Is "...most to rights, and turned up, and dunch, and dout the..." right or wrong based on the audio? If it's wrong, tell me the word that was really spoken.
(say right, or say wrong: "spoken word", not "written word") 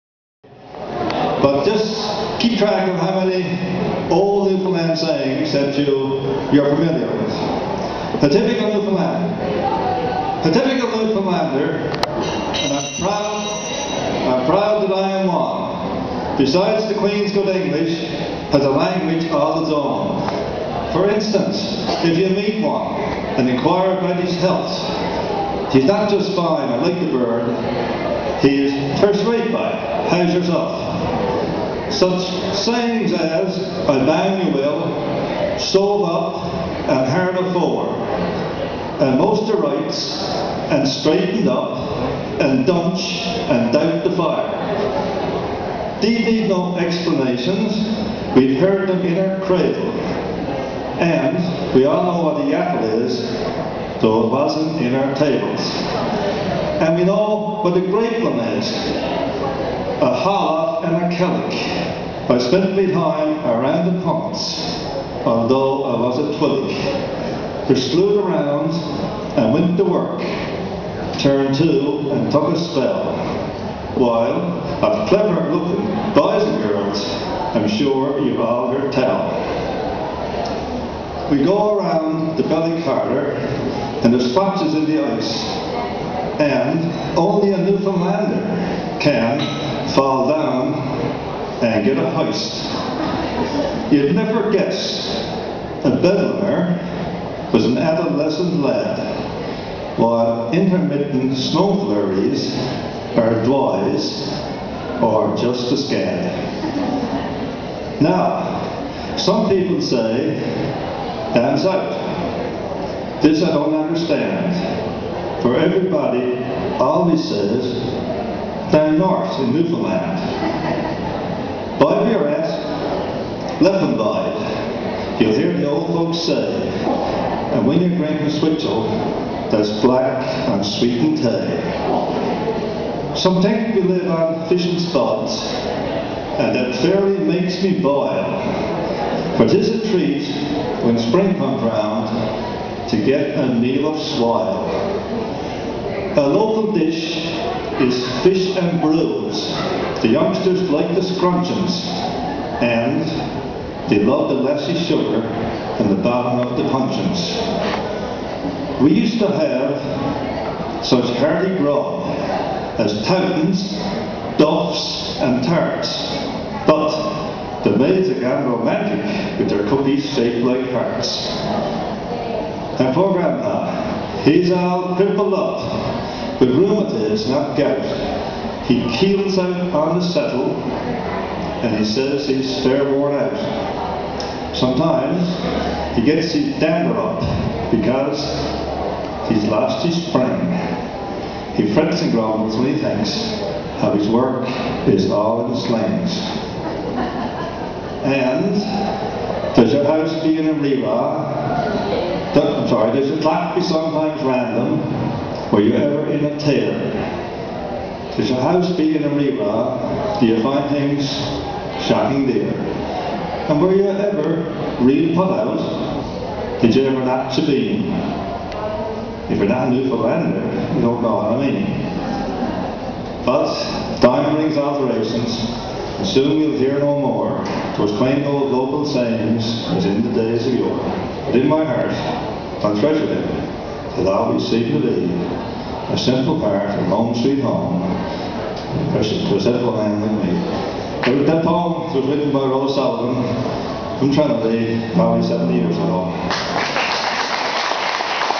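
wrong: "straightened", not "turned".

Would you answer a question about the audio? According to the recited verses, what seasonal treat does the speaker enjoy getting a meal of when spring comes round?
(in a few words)
swile.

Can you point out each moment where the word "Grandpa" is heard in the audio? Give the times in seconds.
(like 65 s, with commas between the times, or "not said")
173 s.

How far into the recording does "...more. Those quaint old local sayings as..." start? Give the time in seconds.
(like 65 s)
226 s.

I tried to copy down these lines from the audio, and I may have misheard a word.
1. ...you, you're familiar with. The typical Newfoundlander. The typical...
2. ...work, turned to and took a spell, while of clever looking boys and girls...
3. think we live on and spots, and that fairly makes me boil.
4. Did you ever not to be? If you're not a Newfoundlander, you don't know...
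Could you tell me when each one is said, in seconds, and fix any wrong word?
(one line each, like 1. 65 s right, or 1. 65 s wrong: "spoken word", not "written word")
1. 5 s right
2. 69 s right
3. 133 s right
4. 216 s right.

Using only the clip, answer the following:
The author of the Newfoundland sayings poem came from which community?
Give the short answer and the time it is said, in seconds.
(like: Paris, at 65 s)
Trinity, at 244 s.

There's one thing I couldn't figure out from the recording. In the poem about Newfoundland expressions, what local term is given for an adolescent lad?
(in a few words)
Bedlamer.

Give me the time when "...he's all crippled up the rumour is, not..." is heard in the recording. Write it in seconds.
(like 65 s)
174 s.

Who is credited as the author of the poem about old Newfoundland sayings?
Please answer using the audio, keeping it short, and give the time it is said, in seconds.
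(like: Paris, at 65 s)
Roy Sullivan, at 242 s.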